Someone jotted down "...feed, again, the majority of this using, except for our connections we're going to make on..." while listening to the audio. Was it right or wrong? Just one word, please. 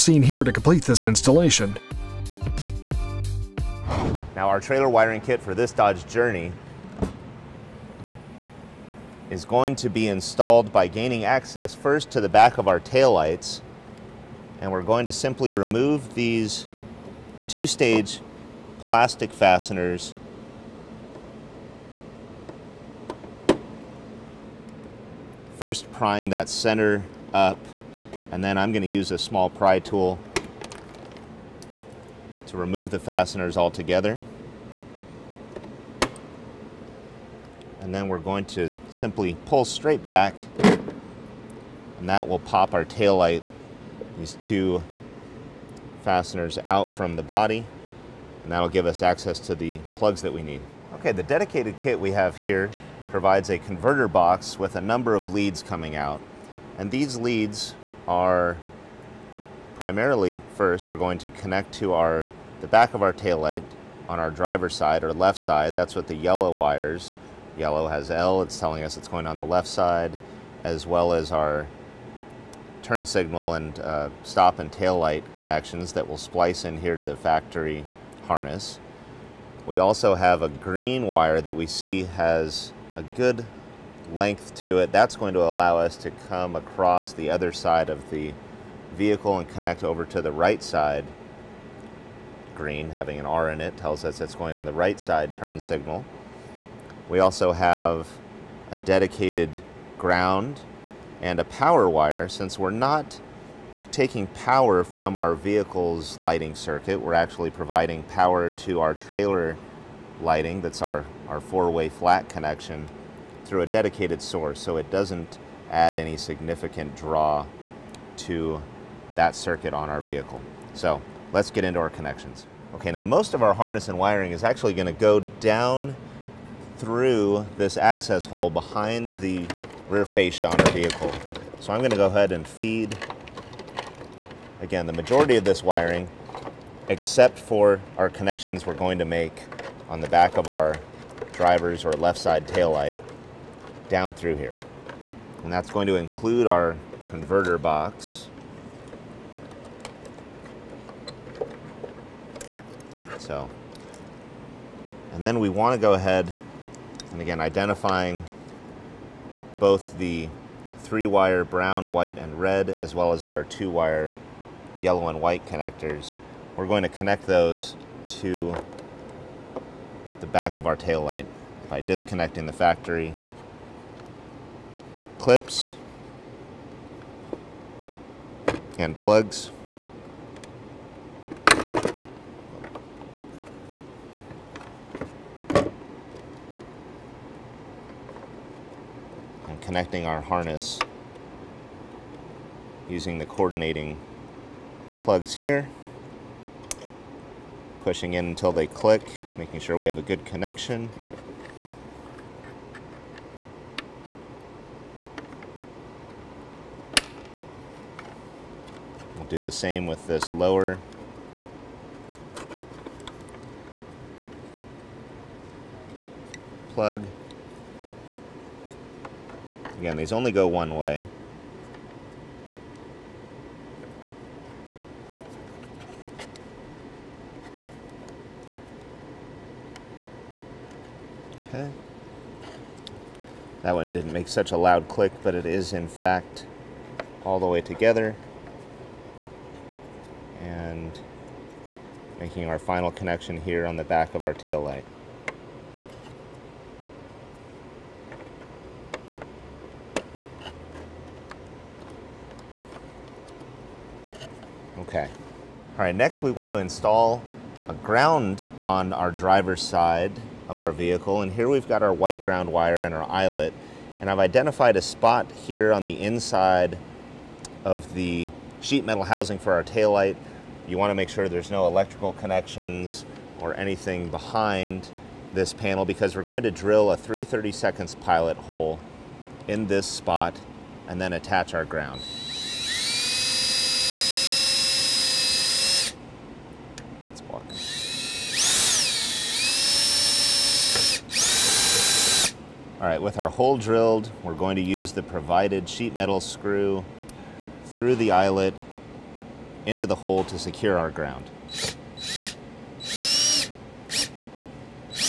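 wrong.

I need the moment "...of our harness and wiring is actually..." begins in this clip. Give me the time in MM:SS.
02:03.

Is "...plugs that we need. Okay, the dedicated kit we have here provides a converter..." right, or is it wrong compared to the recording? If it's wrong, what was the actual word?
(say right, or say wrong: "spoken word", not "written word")
right.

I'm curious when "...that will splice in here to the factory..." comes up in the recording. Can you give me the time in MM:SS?
01:15.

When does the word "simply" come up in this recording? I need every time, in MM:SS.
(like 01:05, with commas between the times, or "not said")
00:15, 00:38.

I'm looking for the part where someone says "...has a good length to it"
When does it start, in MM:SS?
01:22.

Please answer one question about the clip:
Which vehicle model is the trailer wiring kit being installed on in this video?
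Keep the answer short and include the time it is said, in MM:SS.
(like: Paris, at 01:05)
Dodge Journey, at 00:05.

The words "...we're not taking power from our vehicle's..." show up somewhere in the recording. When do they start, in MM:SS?
01:42.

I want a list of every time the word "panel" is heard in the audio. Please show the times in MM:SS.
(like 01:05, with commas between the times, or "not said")
04:35.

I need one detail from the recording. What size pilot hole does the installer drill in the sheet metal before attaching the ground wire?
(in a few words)
3/32.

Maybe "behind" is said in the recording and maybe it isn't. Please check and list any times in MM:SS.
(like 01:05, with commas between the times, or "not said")
02:08, 04:34.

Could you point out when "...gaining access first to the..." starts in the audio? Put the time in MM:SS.
00:10.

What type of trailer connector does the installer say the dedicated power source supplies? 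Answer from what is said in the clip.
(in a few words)
four-way flat.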